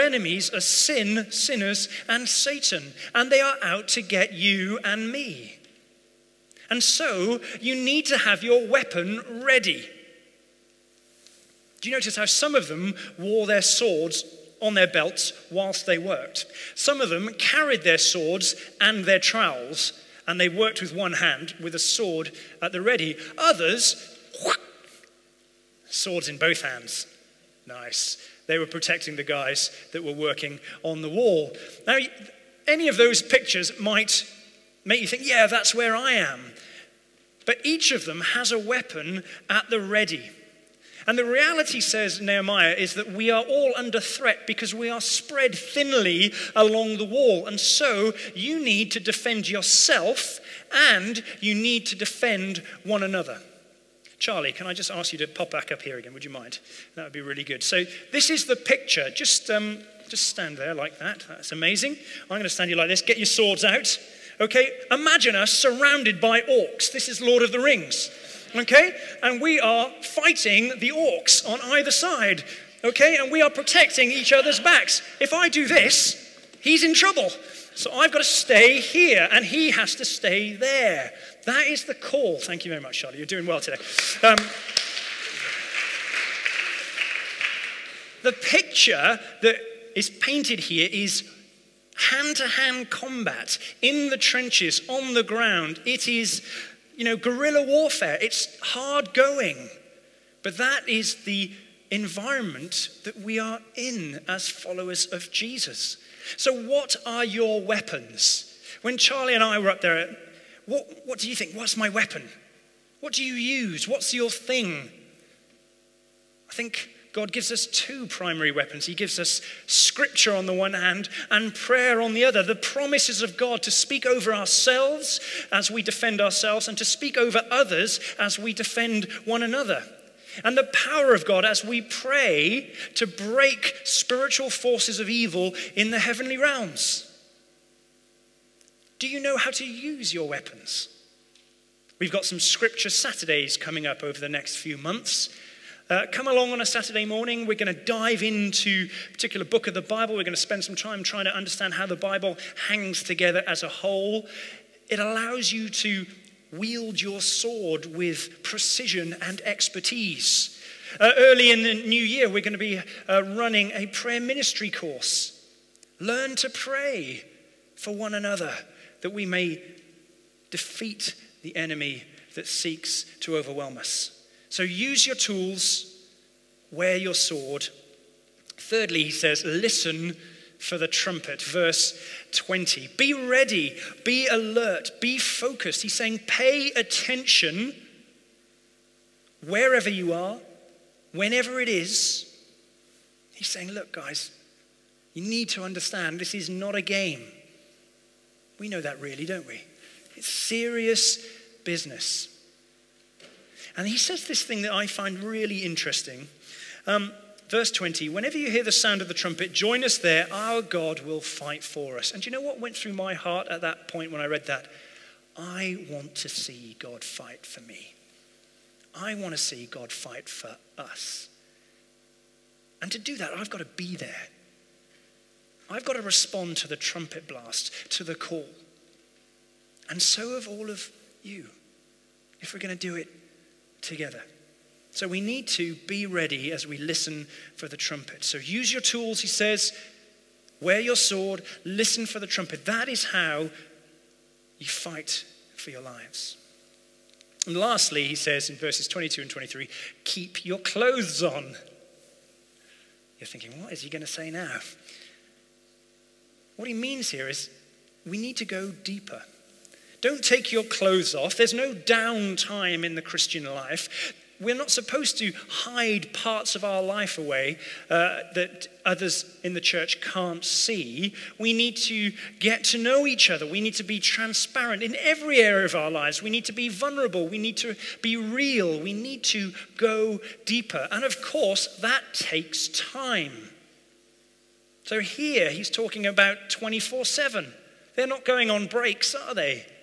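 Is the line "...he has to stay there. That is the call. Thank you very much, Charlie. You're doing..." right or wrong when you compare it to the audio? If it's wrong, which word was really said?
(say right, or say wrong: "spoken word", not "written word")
right.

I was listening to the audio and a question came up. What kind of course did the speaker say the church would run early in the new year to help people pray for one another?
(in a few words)
Prayer ministry course.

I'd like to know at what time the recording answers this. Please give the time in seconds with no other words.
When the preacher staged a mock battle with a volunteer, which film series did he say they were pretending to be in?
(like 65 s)
67 s.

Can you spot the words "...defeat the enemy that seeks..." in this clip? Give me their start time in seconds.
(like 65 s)
170 s.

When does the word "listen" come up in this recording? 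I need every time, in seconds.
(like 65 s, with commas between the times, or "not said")
179 s, 236 s, 241 s.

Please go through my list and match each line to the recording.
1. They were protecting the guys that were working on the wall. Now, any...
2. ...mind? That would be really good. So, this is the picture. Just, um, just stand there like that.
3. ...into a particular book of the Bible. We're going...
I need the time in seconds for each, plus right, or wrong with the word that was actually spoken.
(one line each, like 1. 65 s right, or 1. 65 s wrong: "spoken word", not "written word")
1. 28 s right
2. 56 s right
3. 148 s right.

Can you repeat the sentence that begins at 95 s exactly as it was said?
It is you know, guerrilla warfare.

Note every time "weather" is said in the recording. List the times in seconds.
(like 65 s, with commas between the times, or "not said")
not said.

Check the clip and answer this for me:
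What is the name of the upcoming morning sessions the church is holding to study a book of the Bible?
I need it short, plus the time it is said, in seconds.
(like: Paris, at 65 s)
Scripture Saturdays, at 142 s.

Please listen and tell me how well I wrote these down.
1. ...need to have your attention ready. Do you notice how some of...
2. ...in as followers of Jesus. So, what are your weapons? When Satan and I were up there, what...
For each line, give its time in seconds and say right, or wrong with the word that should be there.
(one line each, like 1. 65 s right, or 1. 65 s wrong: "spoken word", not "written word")
1. 7 s wrong: "weapon", not "attention"
2. 103 s wrong: "Charlie", not "Satan".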